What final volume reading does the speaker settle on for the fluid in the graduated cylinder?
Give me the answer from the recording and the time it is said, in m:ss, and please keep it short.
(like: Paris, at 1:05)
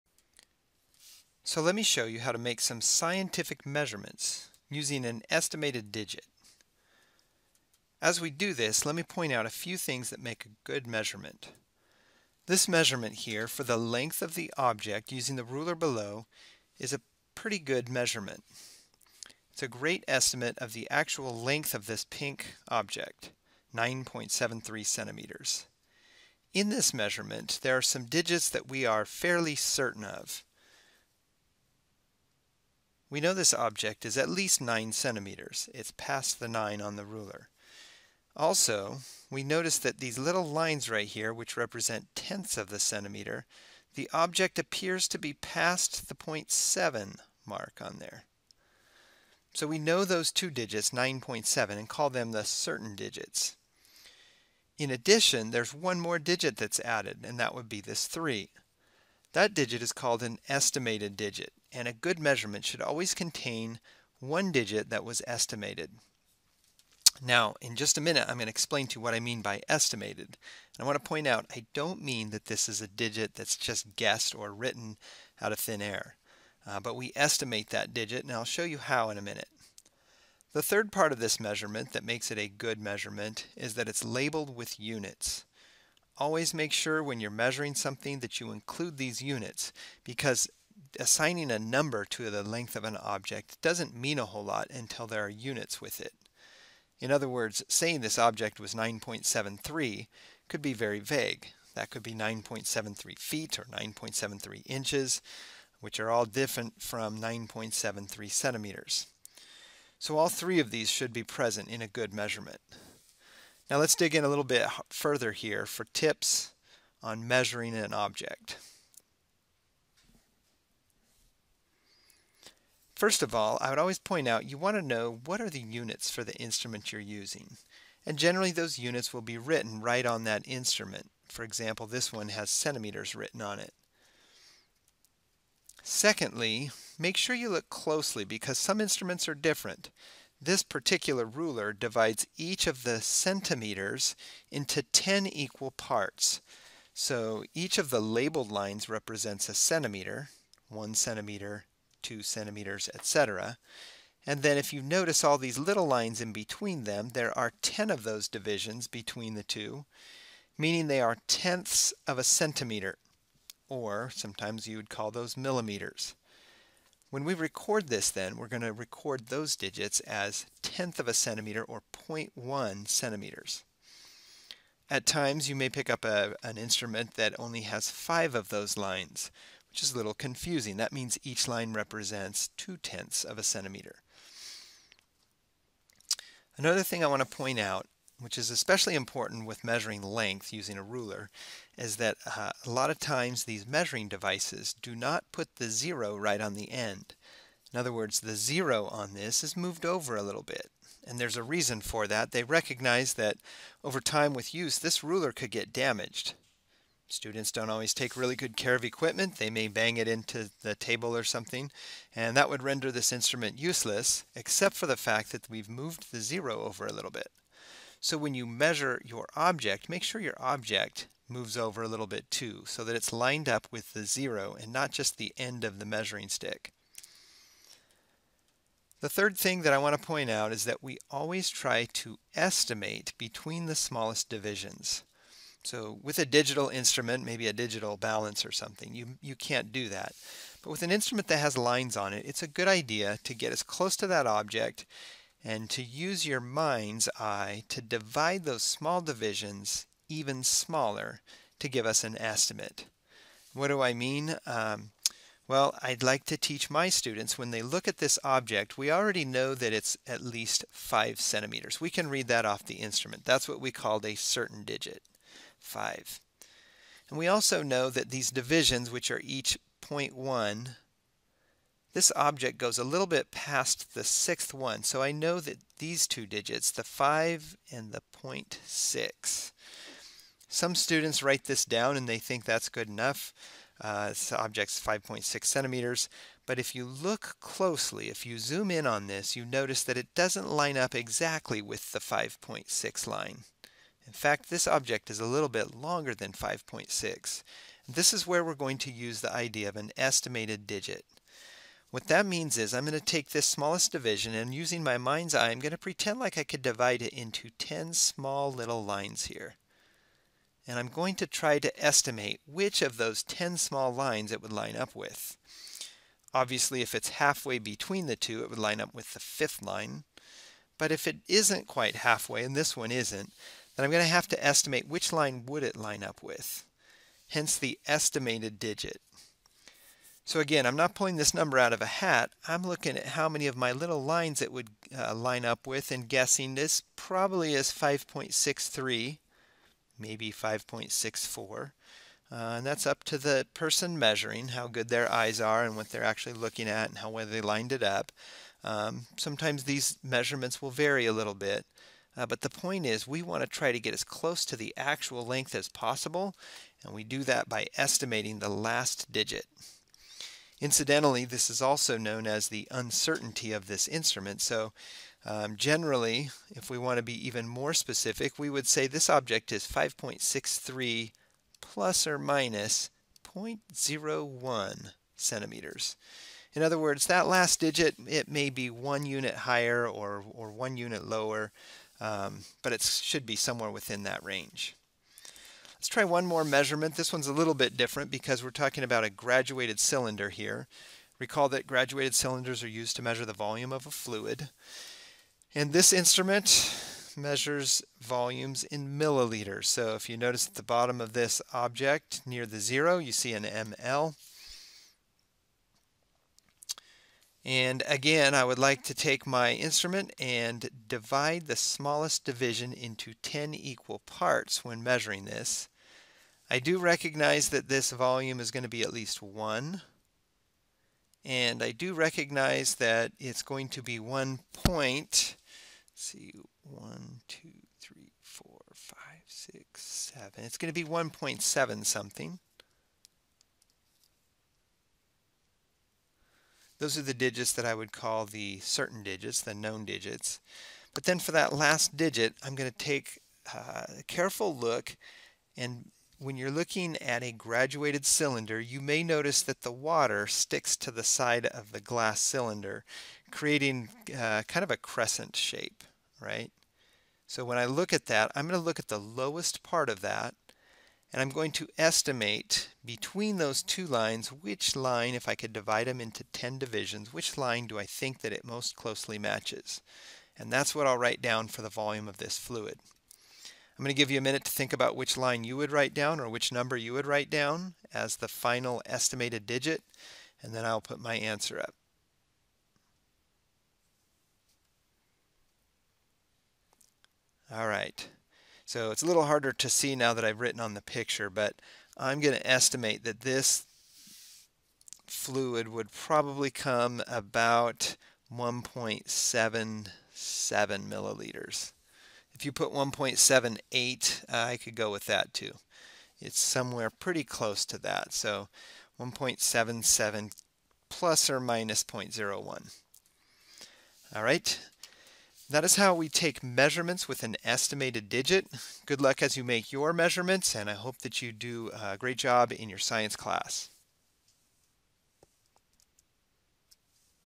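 1.77 milliliters, at 8:18.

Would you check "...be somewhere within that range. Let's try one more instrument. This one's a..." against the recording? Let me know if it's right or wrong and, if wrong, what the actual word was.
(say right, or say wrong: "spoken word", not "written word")
wrong: "measurement", not "instrument".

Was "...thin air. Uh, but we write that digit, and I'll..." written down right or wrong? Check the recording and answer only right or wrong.
wrong.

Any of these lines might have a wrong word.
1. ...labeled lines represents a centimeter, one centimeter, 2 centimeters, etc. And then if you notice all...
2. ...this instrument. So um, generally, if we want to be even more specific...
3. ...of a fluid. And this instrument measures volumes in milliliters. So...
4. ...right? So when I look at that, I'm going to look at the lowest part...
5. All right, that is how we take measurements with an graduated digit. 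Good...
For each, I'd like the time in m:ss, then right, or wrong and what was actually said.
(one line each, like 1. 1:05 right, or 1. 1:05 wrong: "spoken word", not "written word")
1. 2:27 right
2. 6:03 right
3. 6:33 right
4. 7:36 right
5. 8:34 wrong: "estimated", not "graduated".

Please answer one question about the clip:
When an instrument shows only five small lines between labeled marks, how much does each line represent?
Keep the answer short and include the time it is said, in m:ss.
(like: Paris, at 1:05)
two tenths of a centimeter, at 3:02.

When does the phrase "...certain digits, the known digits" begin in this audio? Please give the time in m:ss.
7:18.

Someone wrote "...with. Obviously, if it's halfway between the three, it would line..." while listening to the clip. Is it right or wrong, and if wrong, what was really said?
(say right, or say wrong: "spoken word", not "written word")
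wrong: "two", not "three".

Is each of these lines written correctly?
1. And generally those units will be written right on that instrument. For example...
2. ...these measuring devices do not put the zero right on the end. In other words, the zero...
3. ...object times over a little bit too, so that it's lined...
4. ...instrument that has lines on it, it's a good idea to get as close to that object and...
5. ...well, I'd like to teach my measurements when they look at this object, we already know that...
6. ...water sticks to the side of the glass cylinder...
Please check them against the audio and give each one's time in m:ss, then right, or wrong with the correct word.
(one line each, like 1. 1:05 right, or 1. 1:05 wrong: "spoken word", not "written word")
1. 2:08 right
2. 3:13 right
3. 3:40 wrong: "moves", not "times"
4. 4:00 right
5. 4:15 wrong: "students", not "measurements"
6. 7:29 right.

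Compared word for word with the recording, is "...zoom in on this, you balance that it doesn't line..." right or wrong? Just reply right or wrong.
wrong.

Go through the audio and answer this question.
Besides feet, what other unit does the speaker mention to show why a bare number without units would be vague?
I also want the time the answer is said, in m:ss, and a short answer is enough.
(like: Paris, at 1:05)
inches, at 1:44.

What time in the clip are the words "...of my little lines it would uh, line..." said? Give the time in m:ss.
5:33.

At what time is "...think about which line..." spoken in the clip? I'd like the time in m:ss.
7:54.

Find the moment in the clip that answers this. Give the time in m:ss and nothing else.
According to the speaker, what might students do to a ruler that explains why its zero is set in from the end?
3:29.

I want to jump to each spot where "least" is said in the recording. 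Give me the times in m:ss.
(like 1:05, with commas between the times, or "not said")
0:34, 4:20, 6:58.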